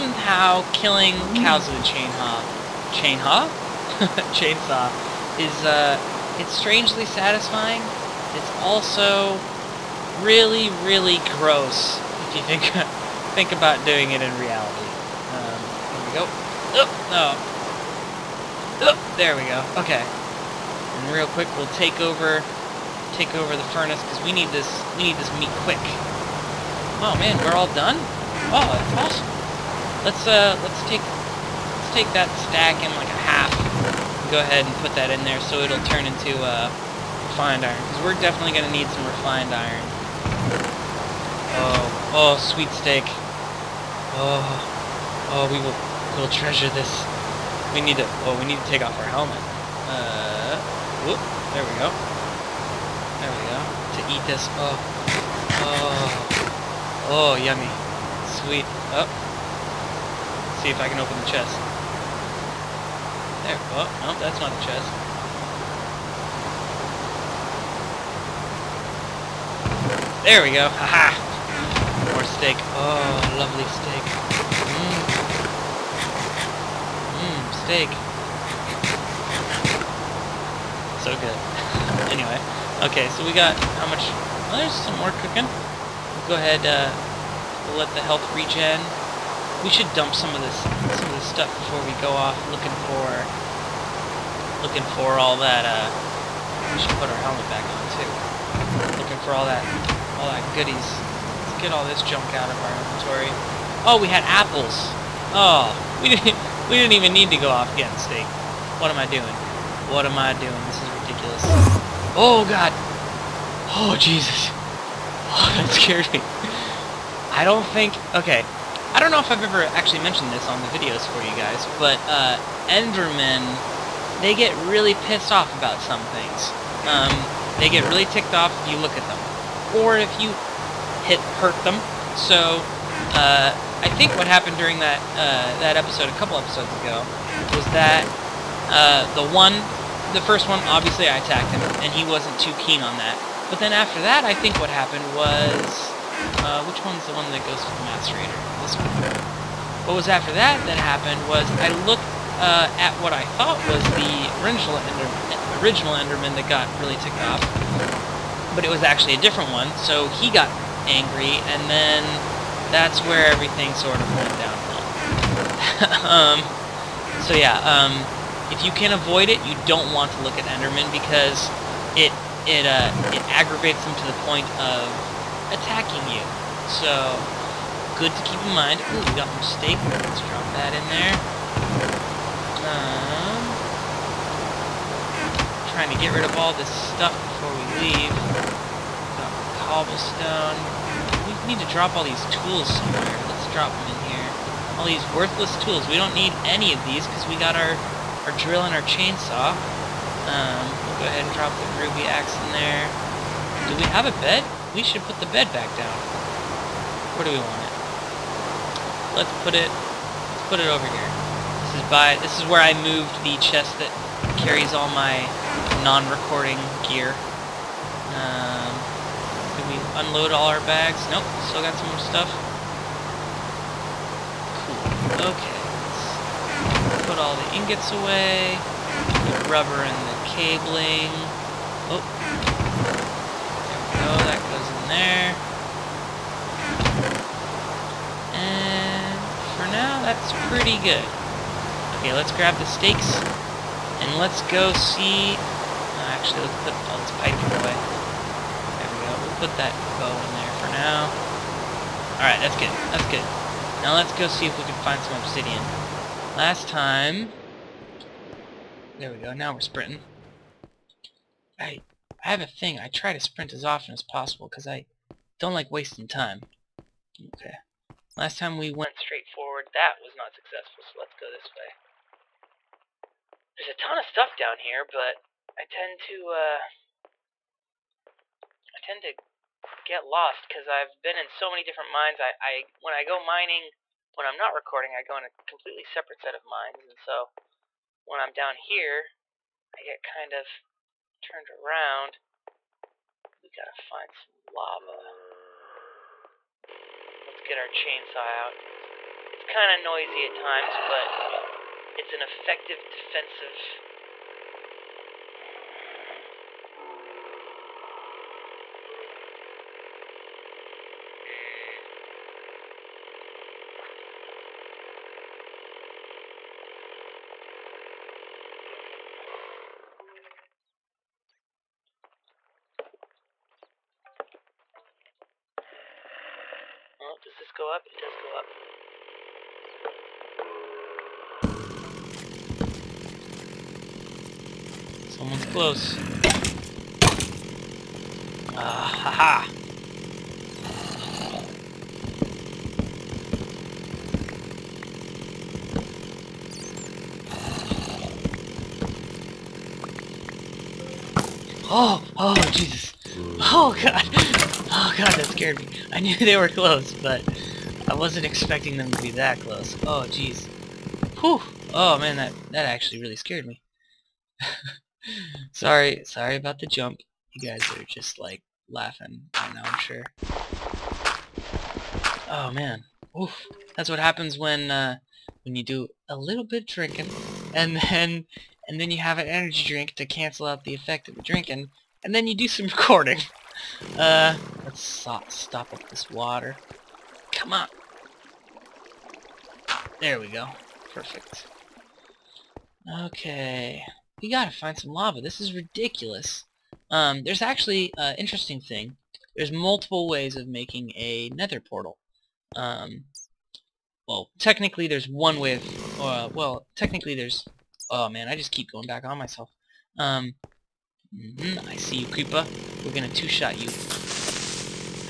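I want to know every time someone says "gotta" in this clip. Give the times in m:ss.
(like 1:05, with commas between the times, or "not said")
4:53, 6:34.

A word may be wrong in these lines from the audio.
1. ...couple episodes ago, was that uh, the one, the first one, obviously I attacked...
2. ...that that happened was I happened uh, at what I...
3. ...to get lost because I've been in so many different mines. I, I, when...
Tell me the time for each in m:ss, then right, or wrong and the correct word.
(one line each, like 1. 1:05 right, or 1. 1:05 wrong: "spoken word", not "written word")
1. 2:16 right
2. 2:30 wrong: "looked", not "happened"
3. 4:39 right.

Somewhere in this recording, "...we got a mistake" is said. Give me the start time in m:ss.
2:59.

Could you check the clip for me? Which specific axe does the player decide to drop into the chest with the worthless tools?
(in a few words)
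Ruby axe.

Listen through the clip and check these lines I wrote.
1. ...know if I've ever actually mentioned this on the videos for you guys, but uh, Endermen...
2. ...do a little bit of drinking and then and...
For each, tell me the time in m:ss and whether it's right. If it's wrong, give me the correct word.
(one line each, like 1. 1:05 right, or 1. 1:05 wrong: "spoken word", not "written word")
1. 1:59 right
2. 6:15 right.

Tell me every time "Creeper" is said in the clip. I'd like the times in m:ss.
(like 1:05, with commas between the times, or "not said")
6:52.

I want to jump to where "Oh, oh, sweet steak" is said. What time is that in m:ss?
0:41.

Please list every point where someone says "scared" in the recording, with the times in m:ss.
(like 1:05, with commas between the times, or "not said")
1:55, 5:55, 6:03.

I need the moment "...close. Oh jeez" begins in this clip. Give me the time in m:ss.
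5:59.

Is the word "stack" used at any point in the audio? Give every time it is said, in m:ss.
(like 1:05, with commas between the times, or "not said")
0:32.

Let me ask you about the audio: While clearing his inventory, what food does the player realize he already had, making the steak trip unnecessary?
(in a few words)
Apples.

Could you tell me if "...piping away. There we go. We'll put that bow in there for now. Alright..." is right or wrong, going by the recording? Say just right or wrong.
right.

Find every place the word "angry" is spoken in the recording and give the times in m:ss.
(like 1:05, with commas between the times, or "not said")
2:40.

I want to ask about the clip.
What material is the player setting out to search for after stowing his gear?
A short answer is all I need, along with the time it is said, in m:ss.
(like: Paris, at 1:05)
Obsidian, at 4:15.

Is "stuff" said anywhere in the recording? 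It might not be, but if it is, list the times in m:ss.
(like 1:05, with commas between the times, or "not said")
1:31, 3:06, 3:42, 4:34.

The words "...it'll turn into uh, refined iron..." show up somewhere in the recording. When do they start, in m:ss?
0:35.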